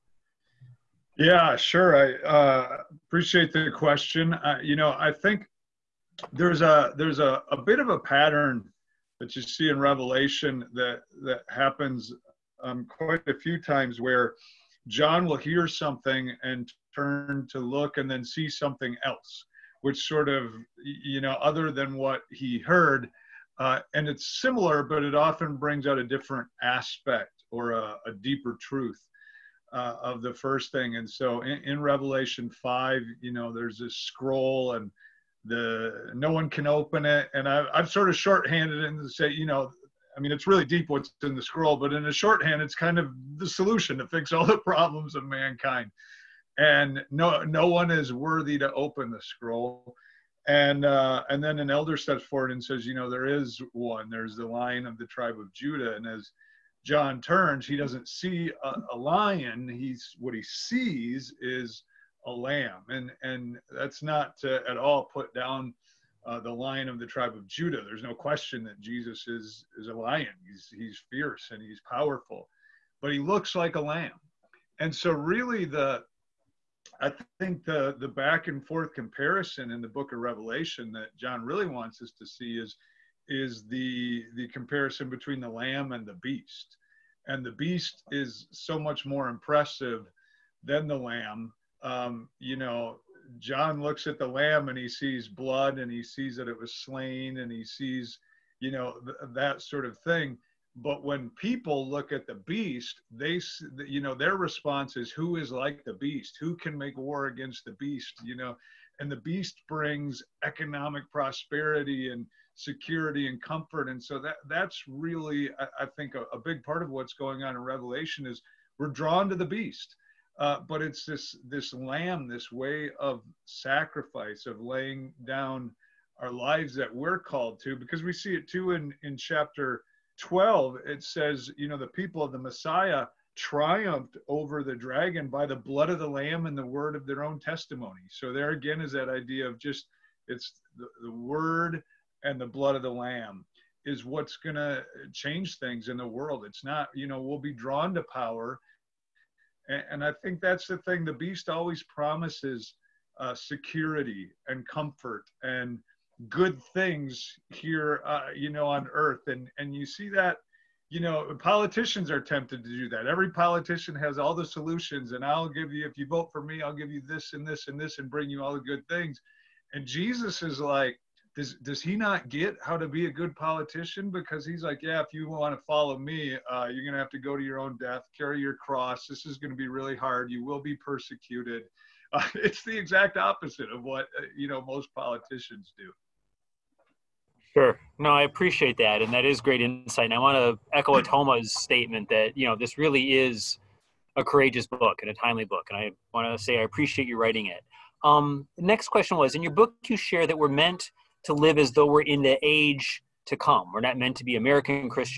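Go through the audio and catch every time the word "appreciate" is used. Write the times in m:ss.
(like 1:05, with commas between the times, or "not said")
0:03, 3:08, 3:16.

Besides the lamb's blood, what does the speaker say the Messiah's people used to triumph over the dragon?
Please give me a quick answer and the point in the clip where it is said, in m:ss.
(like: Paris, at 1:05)
The word of their own testimony, at 2:16.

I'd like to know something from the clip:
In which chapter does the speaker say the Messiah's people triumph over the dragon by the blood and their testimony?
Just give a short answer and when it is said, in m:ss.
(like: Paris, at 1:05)
Chapter 12, at 2:09.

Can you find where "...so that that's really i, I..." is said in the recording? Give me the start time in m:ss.
1:54.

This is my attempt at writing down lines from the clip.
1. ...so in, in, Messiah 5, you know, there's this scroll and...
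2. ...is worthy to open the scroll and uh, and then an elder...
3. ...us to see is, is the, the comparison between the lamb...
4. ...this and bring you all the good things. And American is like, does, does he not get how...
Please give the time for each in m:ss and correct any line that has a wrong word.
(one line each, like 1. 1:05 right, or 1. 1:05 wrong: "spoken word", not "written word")
1. 0:31 wrong: "Revelation", not "Messiah"
2. 0:47 right
3. 1:22 right
4. 2:47 wrong: "Jesus", not "American".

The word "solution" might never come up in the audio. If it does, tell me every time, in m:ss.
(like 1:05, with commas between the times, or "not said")
0:43, 2:44.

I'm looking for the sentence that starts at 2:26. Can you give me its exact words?
It's not, you know, we'll be drawn to power.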